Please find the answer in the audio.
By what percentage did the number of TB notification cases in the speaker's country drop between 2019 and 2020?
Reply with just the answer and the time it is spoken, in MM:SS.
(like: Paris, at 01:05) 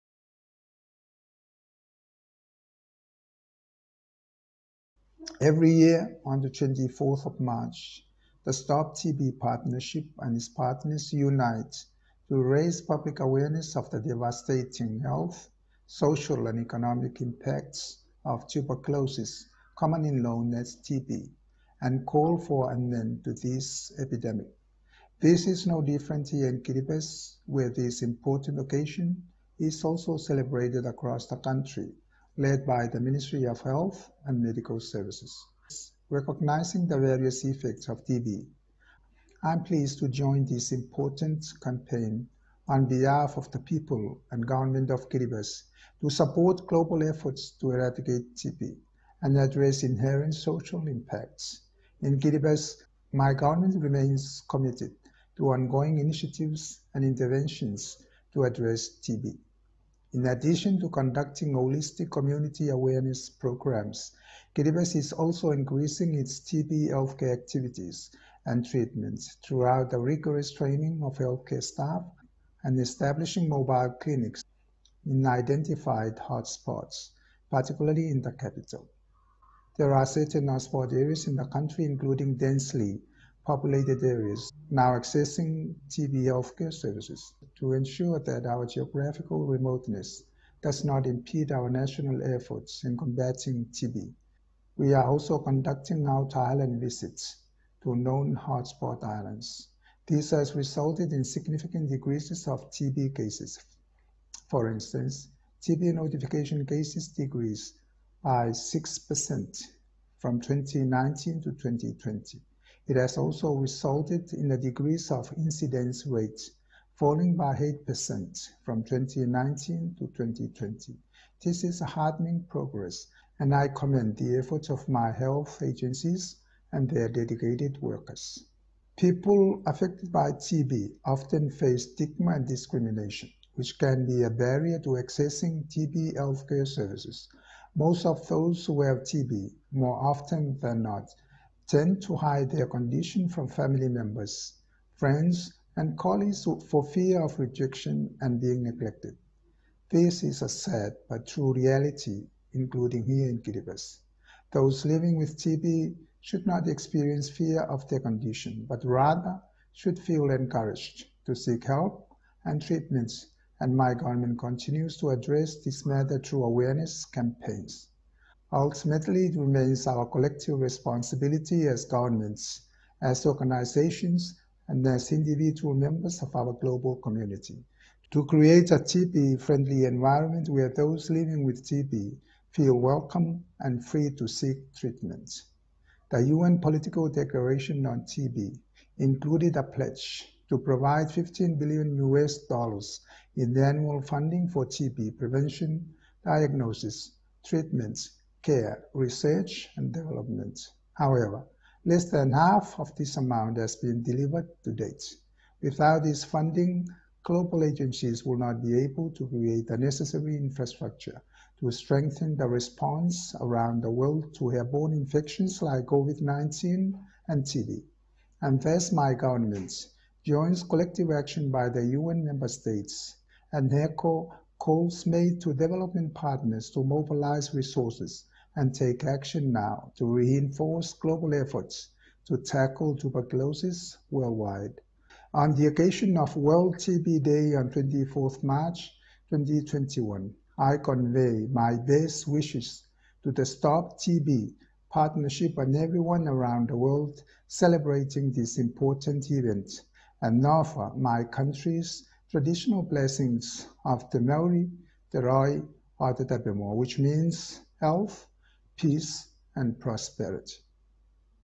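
6%, at 01:48.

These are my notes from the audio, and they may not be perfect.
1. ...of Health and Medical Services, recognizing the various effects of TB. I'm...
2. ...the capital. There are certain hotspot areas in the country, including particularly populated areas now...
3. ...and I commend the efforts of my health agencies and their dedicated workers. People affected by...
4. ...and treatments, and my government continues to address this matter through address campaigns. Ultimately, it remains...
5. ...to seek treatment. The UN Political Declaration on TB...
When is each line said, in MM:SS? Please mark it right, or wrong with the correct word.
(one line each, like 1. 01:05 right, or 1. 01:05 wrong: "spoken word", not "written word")
1. 00:33 right
2. 01:18 wrong: "densely", not "particularly"
3. 02:03 right
4. 02:42 wrong: "awareness", not "address"
5. 03:04 right.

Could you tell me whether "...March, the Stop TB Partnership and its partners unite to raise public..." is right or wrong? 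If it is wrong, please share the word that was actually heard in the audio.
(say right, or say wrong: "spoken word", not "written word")
right.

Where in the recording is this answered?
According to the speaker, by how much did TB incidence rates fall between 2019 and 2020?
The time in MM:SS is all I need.
01:57.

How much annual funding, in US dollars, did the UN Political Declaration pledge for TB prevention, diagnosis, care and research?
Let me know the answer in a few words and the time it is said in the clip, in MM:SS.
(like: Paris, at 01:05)
15 billion US dollars, at 03:11.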